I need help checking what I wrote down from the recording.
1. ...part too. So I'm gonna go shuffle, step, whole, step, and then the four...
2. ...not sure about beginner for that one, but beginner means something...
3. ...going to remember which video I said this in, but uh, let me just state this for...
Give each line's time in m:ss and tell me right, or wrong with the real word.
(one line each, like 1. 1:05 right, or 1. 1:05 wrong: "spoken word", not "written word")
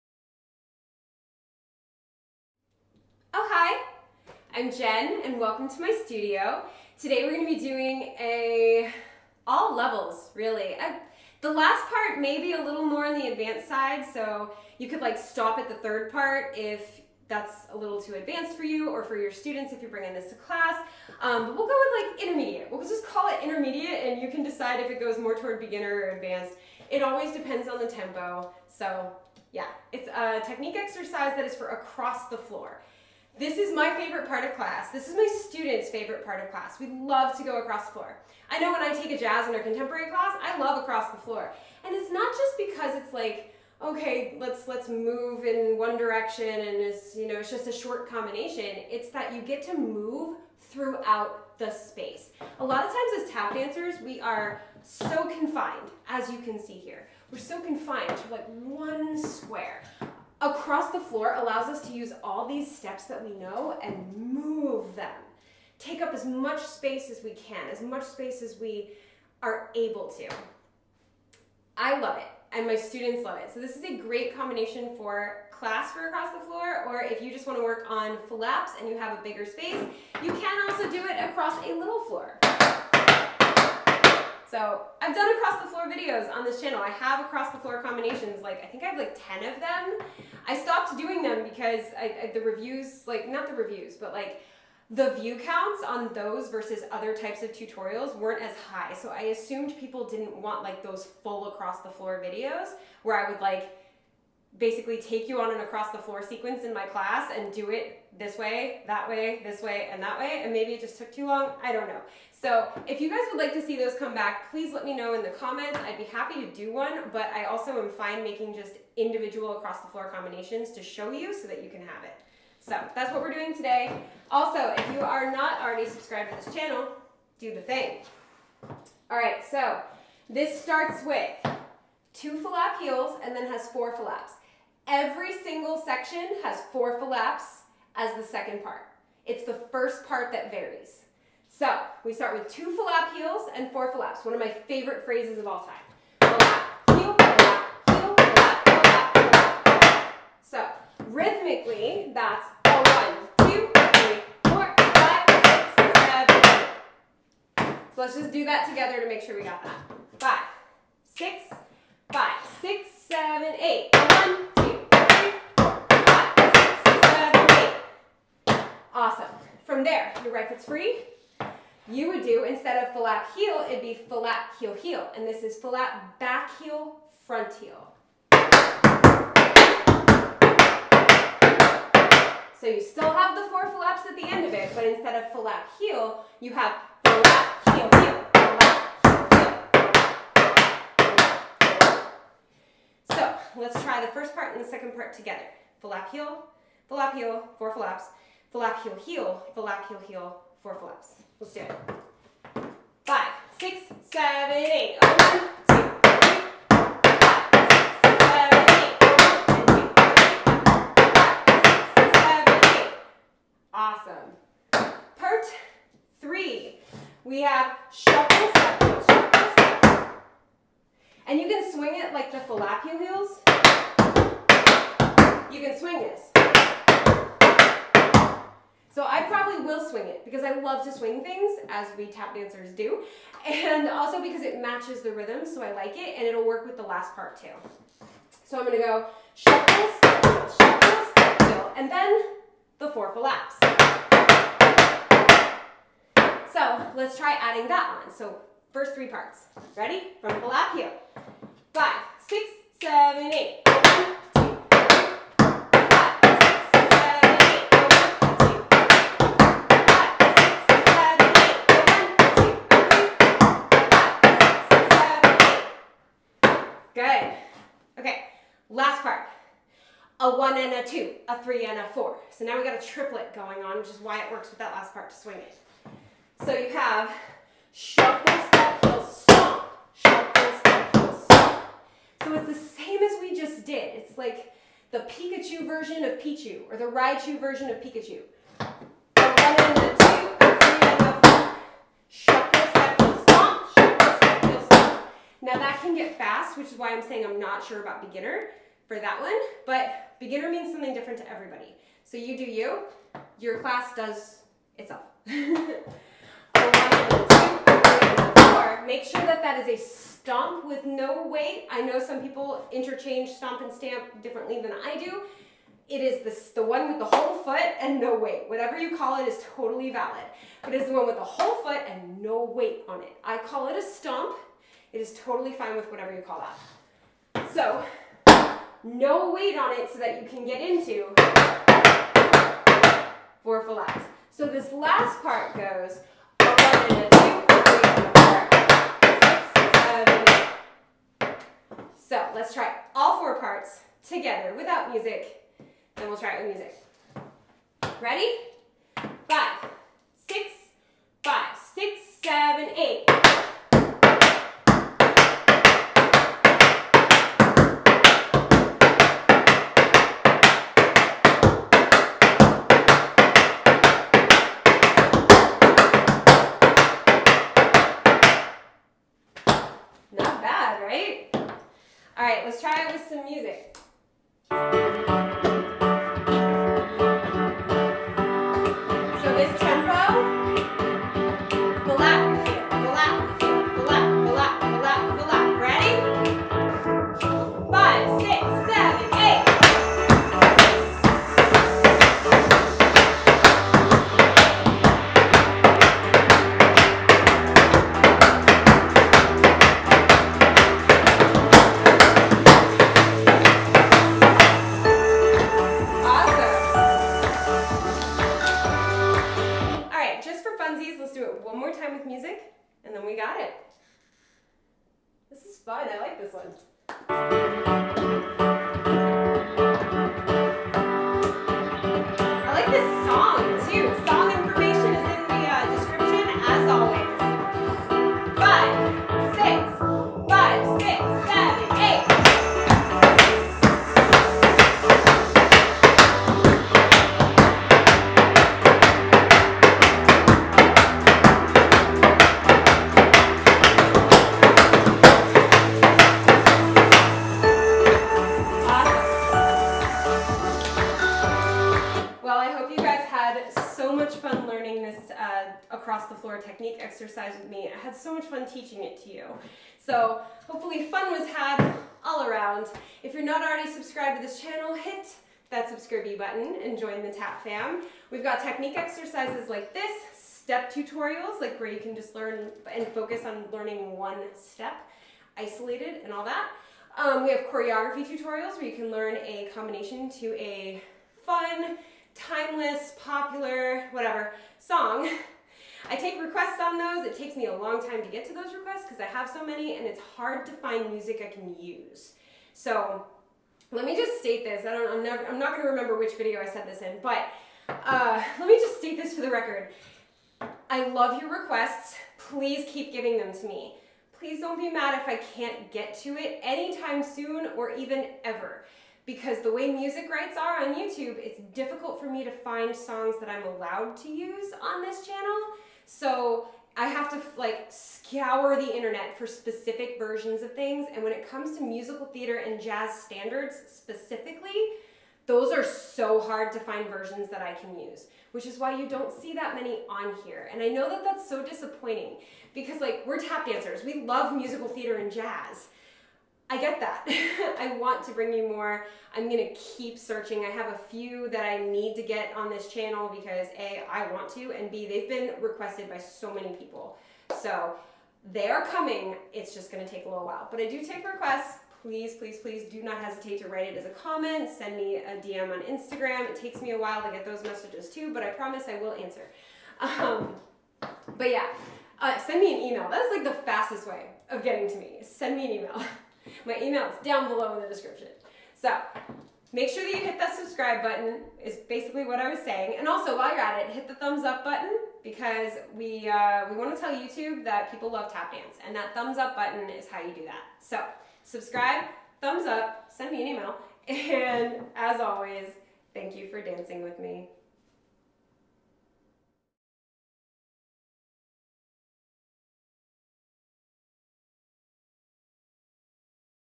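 1. 3:57 wrong: "shuffle", not "whole"
2. 4:57 right
3. 8:15 right.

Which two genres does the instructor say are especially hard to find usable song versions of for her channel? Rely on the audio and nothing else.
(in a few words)
musical theater and jazz standards.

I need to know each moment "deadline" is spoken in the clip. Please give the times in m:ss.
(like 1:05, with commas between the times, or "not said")
not said.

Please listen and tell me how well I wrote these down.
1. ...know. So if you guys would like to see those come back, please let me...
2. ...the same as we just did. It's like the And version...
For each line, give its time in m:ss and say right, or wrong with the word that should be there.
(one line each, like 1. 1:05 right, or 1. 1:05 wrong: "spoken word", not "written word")
1. 1:51 right
2. 4:42 wrong: "Pikachu", not "And".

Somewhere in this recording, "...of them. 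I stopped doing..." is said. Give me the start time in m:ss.
1:29.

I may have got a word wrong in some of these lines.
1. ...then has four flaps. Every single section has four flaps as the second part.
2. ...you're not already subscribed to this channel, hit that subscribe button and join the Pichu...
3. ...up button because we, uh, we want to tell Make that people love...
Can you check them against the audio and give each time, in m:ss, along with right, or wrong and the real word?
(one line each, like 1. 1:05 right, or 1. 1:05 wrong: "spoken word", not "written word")
1. 2:13 right
2. 7:43 wrong: "TAP", not "Pichu"
3. 9:34 wrong: "YouTube", not "Make".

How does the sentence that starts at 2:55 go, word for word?
And this is flap back heel, front heel.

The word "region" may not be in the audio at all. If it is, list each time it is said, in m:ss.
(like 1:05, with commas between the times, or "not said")
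not said.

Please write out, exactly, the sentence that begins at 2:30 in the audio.
So rhythmically, that's a one, two, three, four, So let's just do that together to make sure we got that.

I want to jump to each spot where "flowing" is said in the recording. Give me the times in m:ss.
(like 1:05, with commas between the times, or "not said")
not said.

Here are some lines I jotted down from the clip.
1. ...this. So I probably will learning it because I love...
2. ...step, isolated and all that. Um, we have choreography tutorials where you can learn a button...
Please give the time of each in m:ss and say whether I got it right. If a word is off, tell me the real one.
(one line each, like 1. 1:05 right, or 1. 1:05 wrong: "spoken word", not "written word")
1. 3:46 wrong: "swing", not "learning"
2. 7:54 wrong: "combination", not "button".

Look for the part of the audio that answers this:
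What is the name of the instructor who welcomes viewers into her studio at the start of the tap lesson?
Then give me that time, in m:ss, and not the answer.
0:04.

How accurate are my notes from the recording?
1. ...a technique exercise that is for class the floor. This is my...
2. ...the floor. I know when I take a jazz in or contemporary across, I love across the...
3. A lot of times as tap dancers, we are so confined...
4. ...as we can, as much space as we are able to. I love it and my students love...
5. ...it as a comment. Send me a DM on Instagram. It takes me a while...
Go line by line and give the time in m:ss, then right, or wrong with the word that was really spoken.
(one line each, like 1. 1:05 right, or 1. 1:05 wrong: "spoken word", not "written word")
1. 0:30 wrong: "across", not "class"
2. 0:37 wrong: "class", not "across"
3. 0:52 right
4. 1:07 right
5. 9:13 right.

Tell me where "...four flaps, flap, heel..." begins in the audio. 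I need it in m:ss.
3:17.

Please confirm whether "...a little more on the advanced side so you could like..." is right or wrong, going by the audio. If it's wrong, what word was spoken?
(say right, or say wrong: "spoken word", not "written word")
right.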